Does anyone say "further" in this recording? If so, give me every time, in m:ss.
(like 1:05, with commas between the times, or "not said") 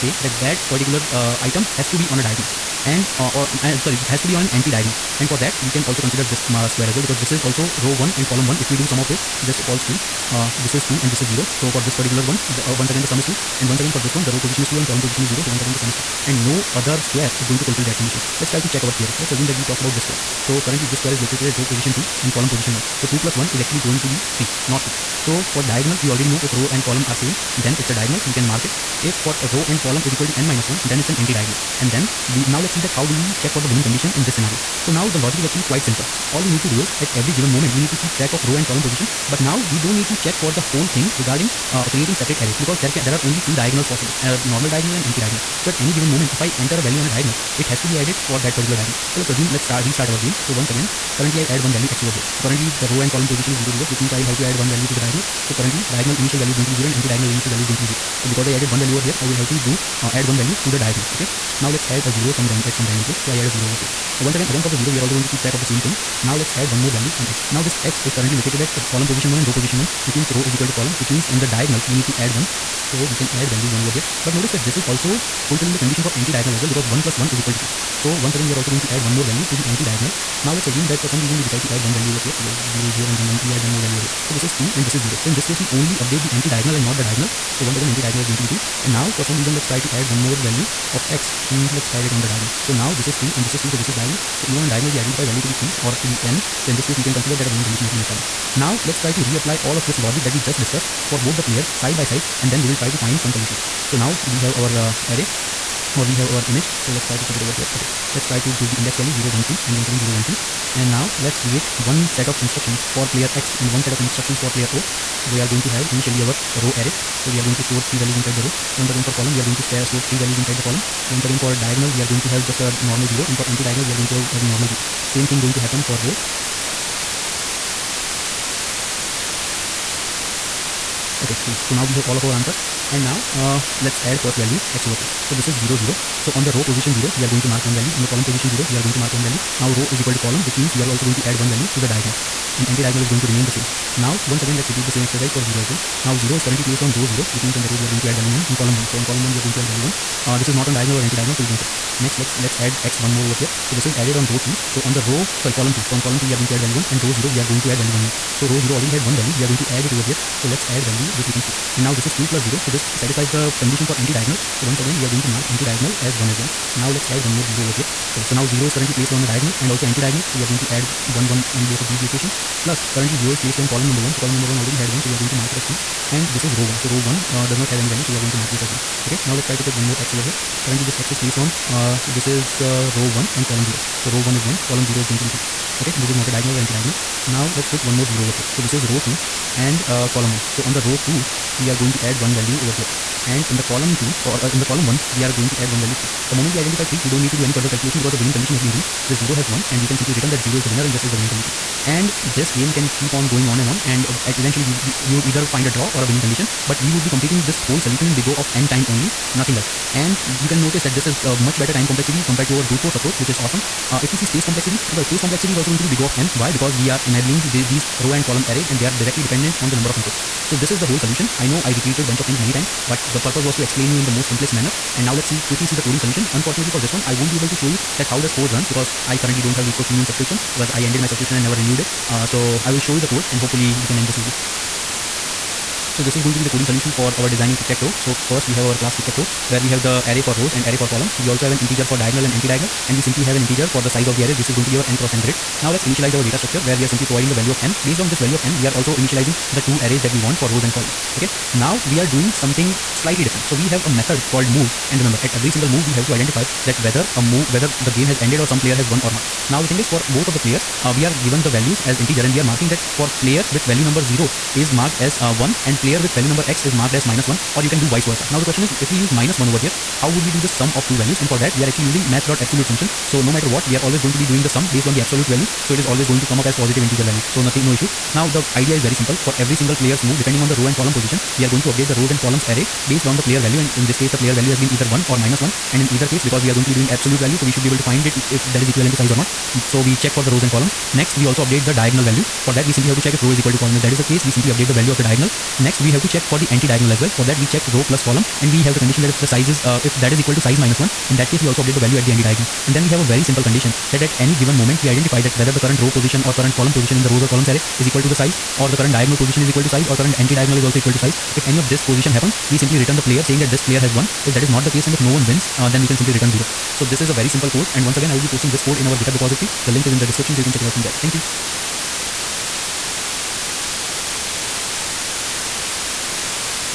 3:17.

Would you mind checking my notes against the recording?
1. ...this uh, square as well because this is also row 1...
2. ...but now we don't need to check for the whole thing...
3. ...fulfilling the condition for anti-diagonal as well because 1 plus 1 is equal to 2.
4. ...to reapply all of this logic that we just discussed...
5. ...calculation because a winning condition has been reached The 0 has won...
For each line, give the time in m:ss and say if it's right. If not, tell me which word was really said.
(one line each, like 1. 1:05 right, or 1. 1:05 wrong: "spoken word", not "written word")
1. 0:06 right
2. 0:39 right
3. 1:15 right
4. 1:39 right
5. 3:17 right.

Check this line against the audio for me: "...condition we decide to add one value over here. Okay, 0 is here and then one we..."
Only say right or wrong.
wrong.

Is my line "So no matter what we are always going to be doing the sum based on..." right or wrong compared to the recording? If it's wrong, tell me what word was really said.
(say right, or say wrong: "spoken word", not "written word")
right.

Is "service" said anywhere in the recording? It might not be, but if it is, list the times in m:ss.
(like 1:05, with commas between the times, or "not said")
not said.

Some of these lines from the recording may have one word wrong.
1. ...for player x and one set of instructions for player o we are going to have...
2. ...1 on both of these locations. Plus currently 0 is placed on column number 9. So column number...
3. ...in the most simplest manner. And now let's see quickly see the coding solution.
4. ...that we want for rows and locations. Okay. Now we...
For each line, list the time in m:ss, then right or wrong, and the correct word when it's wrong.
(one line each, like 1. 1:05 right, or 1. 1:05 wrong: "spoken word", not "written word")
1. 1:52 right
2. 2:51 wrong: "1", not "9"
3. 3:43 right
4. 4:10 wrong: "columns", not "locations".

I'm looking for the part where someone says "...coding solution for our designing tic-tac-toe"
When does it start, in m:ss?
3:56.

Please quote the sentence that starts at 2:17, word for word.
On the column position 0, we are going to mark one value.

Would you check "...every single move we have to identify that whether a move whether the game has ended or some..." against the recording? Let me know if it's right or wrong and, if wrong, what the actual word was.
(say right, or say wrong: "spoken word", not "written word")
right.